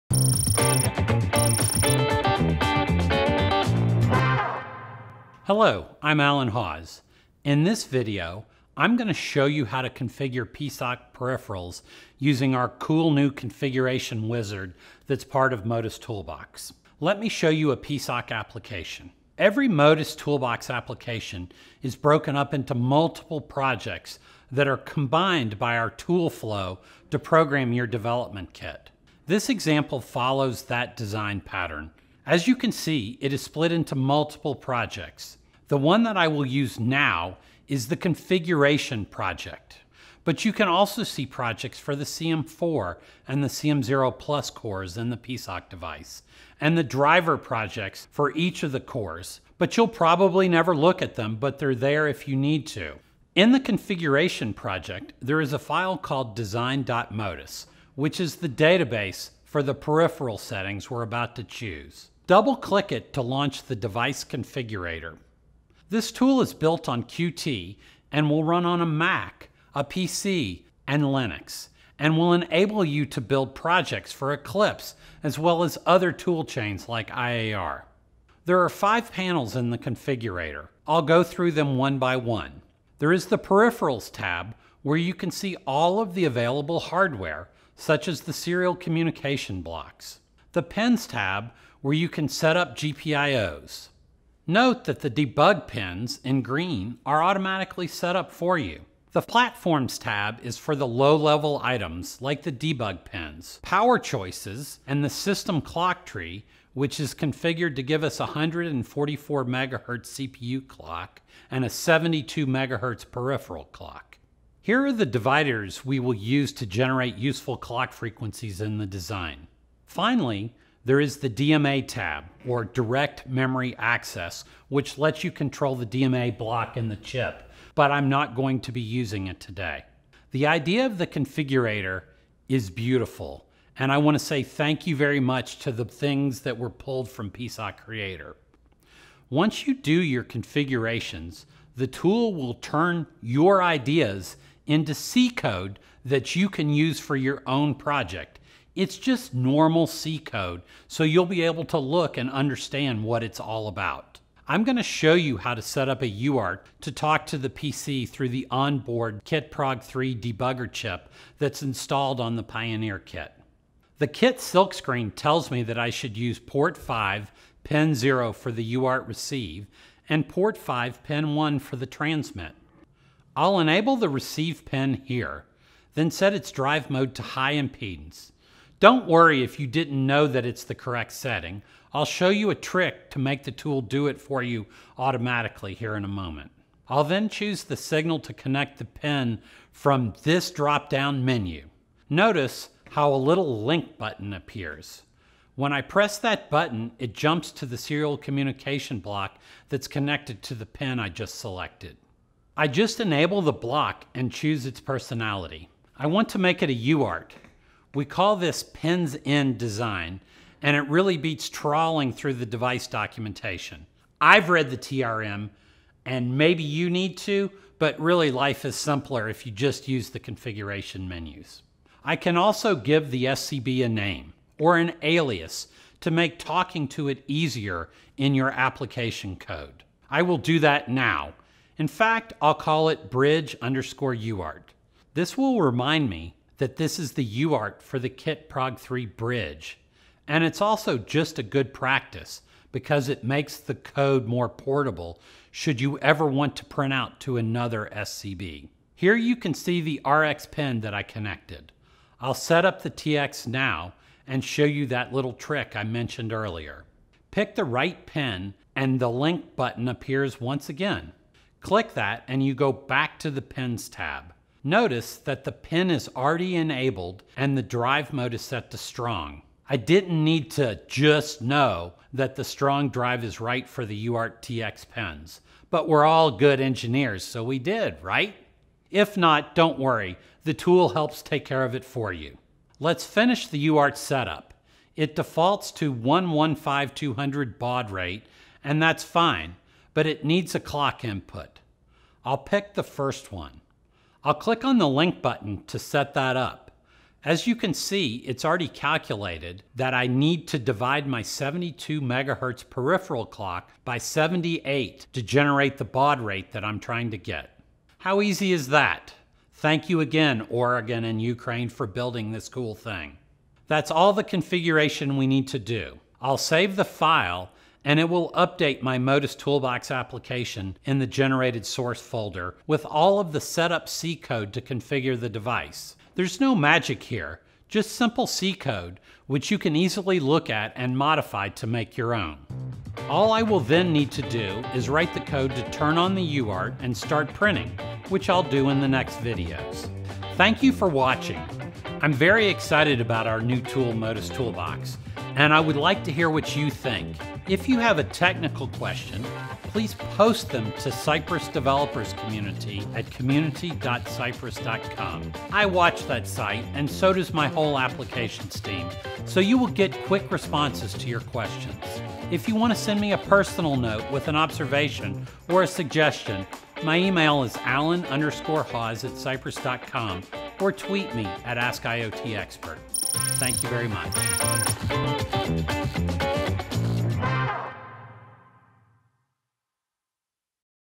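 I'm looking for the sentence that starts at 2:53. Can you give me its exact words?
I'll enable the receive pin here, then set its drive mode to high impedance.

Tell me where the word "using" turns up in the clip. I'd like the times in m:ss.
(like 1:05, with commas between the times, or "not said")
0:12, 2:08.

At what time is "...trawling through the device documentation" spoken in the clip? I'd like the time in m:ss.
3:31.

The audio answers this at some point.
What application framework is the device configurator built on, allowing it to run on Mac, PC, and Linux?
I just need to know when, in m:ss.
1:07.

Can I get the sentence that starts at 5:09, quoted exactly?
Thank you again, Oregon and Ukraine, for building this cool thing.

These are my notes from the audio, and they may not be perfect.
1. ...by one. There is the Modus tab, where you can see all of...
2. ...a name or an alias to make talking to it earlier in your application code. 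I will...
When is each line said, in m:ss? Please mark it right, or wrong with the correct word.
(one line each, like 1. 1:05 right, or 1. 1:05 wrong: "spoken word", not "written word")
1. 1:21 wrong: "Peripherals", not "Modus"
2. 3:43 wrong: "easier", not "earlier".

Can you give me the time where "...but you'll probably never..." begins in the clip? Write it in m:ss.
0:49.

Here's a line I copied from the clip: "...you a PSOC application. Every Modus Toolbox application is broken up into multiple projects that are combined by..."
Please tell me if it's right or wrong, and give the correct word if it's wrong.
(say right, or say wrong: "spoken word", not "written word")
right.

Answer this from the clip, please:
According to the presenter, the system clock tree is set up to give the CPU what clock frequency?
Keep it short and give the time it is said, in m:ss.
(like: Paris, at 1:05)
144 MHz, at 1:48.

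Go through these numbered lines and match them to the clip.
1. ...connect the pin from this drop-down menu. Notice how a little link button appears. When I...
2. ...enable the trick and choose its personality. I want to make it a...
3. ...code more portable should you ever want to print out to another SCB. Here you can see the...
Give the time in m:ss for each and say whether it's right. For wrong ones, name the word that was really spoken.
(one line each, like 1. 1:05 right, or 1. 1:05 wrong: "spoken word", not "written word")
1. 3:08 right
2. 3:22 wrong: "block", not "trick"
3. 4:03 right.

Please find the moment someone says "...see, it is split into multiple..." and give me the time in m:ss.
0:32.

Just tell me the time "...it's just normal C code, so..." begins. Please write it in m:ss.
2:28.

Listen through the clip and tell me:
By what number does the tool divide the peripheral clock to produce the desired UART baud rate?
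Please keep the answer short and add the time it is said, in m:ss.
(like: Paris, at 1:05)
78, at 5:03.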